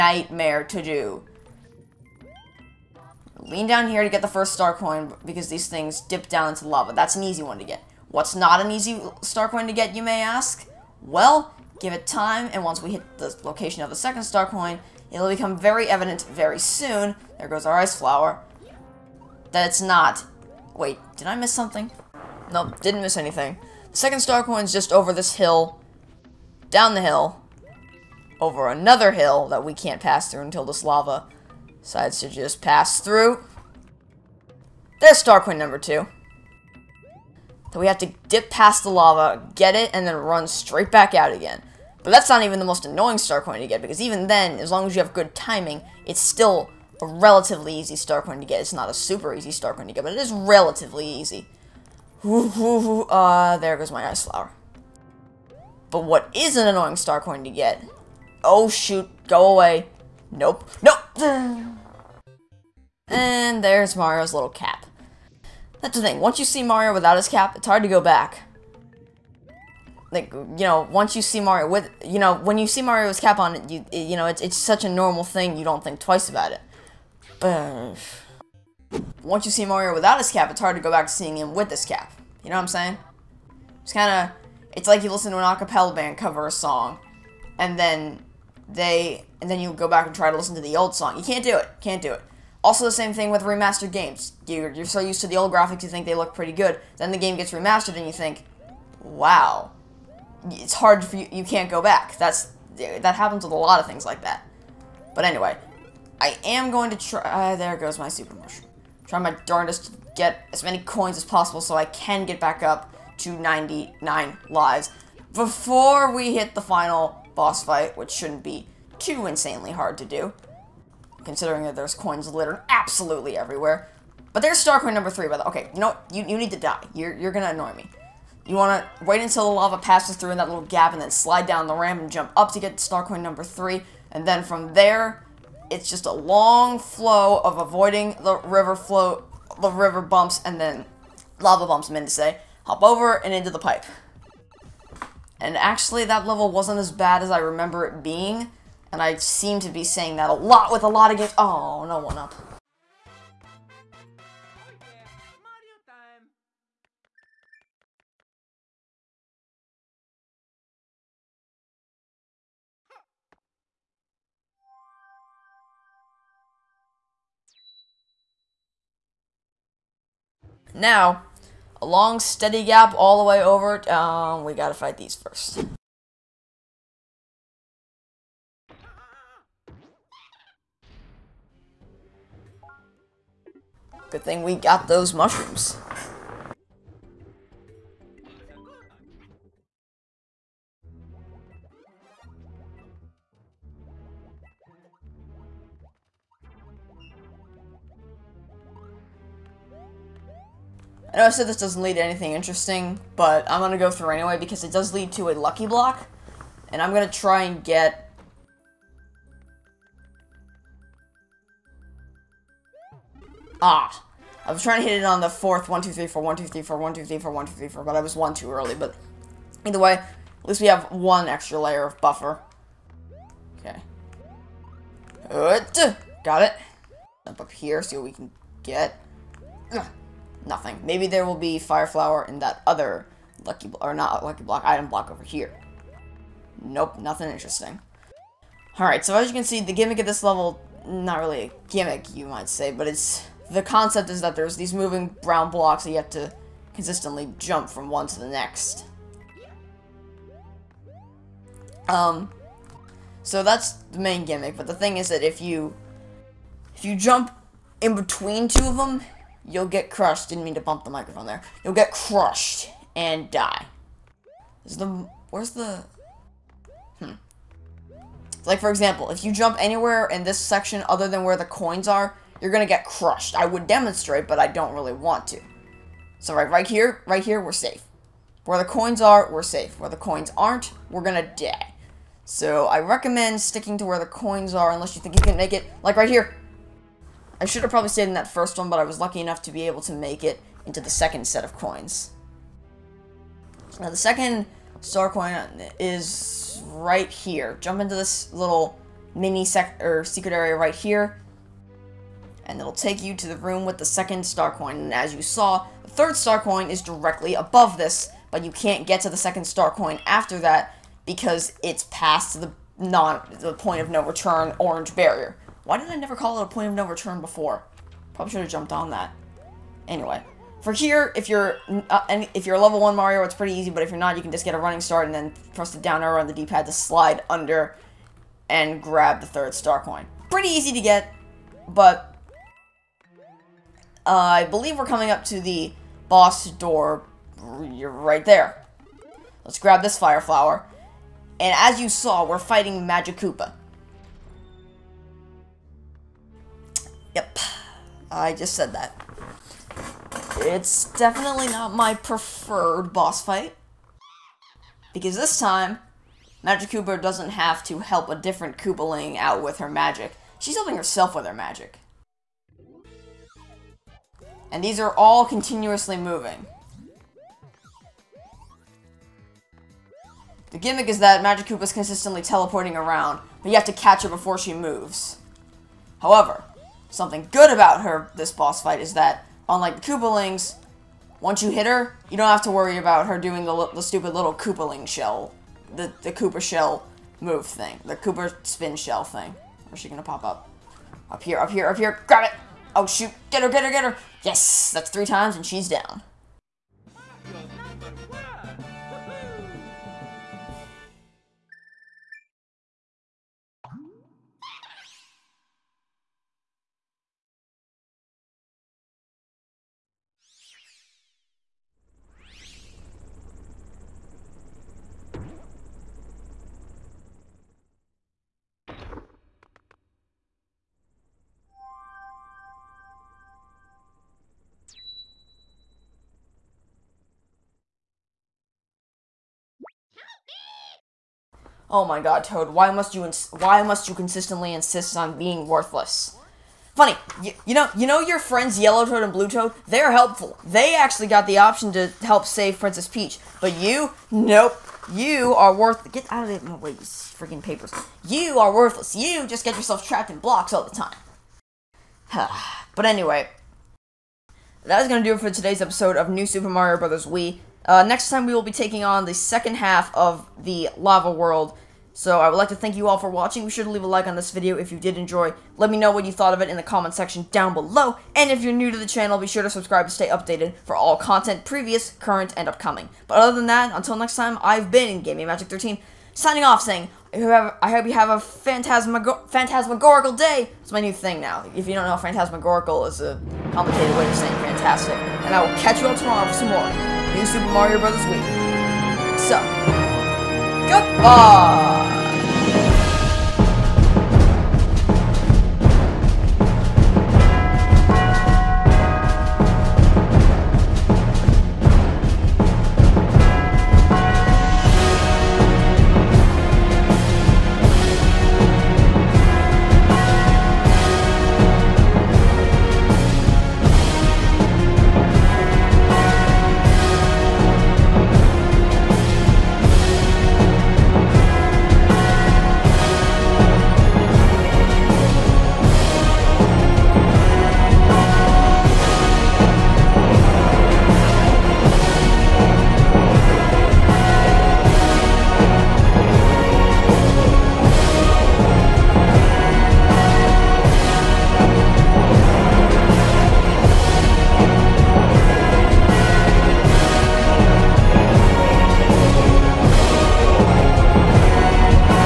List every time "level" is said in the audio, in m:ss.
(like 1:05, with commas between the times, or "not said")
2:26, 4:00, 5:22.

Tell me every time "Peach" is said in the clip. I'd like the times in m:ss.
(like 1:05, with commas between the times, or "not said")
7:22.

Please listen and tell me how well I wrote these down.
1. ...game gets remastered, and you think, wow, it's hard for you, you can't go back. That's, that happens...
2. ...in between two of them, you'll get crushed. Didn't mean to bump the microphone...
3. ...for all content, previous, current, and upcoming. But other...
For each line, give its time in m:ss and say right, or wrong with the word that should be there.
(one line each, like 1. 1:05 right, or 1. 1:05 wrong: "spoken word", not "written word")
1. 1:37 right
2. 4:17 right
3. 7:50 right.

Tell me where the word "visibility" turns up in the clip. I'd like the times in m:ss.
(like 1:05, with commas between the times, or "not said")
not said.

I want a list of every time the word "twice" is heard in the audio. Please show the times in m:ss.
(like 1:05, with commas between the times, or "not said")
1:15.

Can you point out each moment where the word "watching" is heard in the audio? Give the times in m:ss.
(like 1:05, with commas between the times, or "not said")
7:43.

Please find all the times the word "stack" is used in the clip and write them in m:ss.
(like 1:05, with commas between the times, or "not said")
not said.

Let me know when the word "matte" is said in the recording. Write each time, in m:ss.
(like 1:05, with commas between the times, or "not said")
not said.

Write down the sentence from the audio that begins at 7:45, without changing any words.
Let me know what you thought of it in the comment section down below.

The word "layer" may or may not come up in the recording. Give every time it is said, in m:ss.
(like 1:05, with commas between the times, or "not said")
3:41.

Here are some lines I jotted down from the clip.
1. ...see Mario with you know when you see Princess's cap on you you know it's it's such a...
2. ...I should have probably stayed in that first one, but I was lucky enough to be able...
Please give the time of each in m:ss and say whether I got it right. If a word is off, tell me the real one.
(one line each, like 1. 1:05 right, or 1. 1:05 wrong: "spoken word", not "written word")
1. 1:11 wrong: "Mario", not "Princess"
2. 4:47 right.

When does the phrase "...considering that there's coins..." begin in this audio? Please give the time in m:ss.
2:01.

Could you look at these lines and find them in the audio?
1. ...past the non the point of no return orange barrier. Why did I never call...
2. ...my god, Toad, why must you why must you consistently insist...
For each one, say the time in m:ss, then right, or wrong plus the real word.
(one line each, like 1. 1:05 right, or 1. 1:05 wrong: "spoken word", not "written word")
1. 5:11 right
2. 7:11 right.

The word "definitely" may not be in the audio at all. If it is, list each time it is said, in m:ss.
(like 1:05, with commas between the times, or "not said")
5:50.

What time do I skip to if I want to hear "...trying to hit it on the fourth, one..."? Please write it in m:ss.
3:34.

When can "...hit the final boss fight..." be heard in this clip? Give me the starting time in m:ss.
1:56.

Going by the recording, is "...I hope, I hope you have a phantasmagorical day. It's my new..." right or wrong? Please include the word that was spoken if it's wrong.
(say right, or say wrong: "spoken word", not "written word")
right.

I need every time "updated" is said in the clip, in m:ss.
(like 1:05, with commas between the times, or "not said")
7:50.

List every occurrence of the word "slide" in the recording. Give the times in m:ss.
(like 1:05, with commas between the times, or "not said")
2:11, 5:26.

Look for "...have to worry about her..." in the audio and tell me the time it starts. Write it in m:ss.
6:22.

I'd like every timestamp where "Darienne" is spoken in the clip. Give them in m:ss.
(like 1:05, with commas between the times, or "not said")
not said.